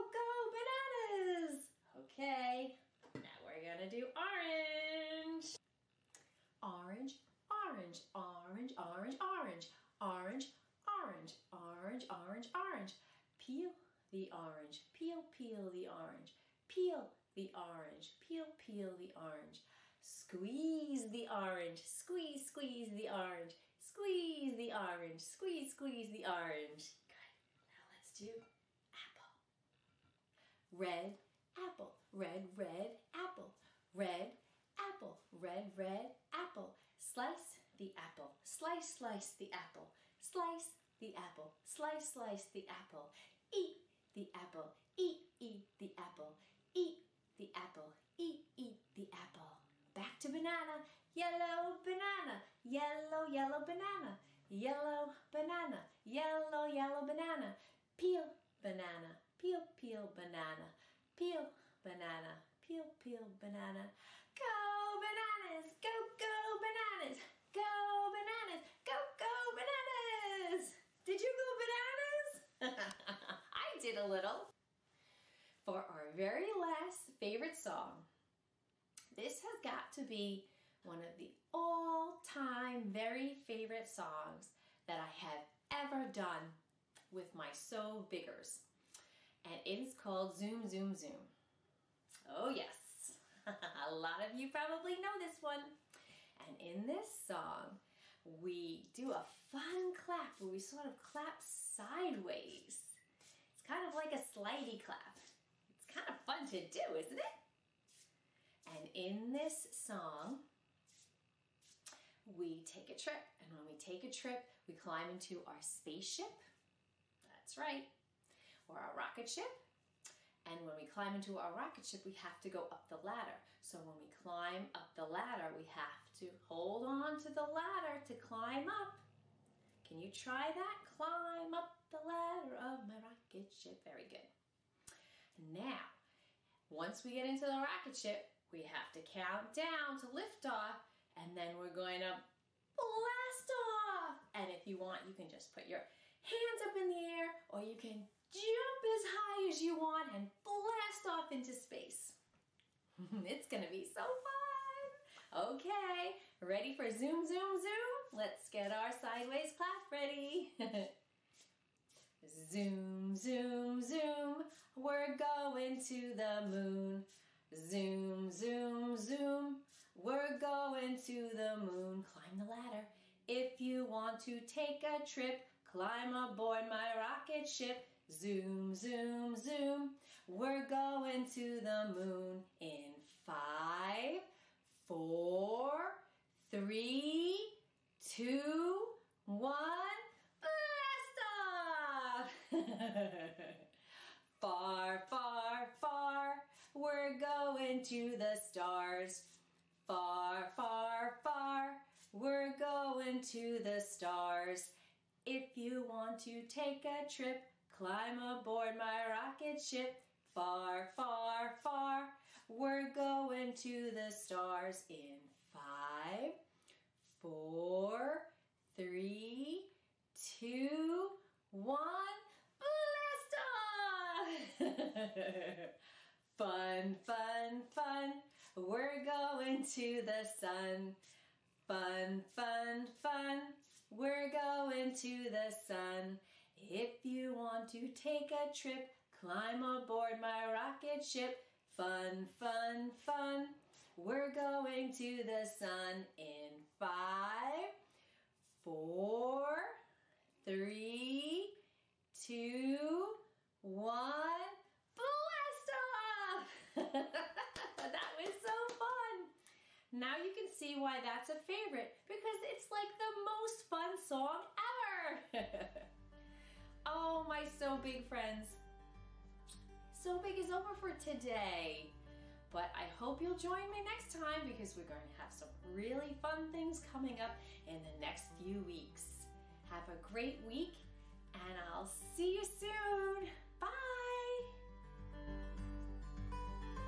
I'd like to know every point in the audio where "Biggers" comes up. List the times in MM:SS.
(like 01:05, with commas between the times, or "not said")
01:28.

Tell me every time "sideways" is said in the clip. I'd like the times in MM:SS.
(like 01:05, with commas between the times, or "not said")
01:41, 02:38.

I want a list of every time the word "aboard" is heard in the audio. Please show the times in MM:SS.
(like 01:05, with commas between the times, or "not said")
02:56, 03:28, 03:59.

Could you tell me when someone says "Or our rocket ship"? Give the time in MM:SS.
01:58.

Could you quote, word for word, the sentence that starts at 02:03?
So when we climb up the ladder, we have to hold on to the ladder to climb up.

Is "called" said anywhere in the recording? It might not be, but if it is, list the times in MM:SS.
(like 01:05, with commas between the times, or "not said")
01:29.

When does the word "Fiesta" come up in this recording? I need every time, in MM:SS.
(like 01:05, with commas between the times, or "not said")
03:44.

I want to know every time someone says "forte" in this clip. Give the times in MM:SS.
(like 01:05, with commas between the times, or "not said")
not said.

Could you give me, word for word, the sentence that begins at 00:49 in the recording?
Back to banana, yellow banana, yellow, yellow banana, yellow banana, yellow, yellow banana.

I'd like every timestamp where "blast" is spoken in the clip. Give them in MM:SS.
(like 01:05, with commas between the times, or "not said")
02:22, 02:30, 03:10, 03:42, 04:14.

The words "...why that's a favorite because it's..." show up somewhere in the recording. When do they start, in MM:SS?
04:20.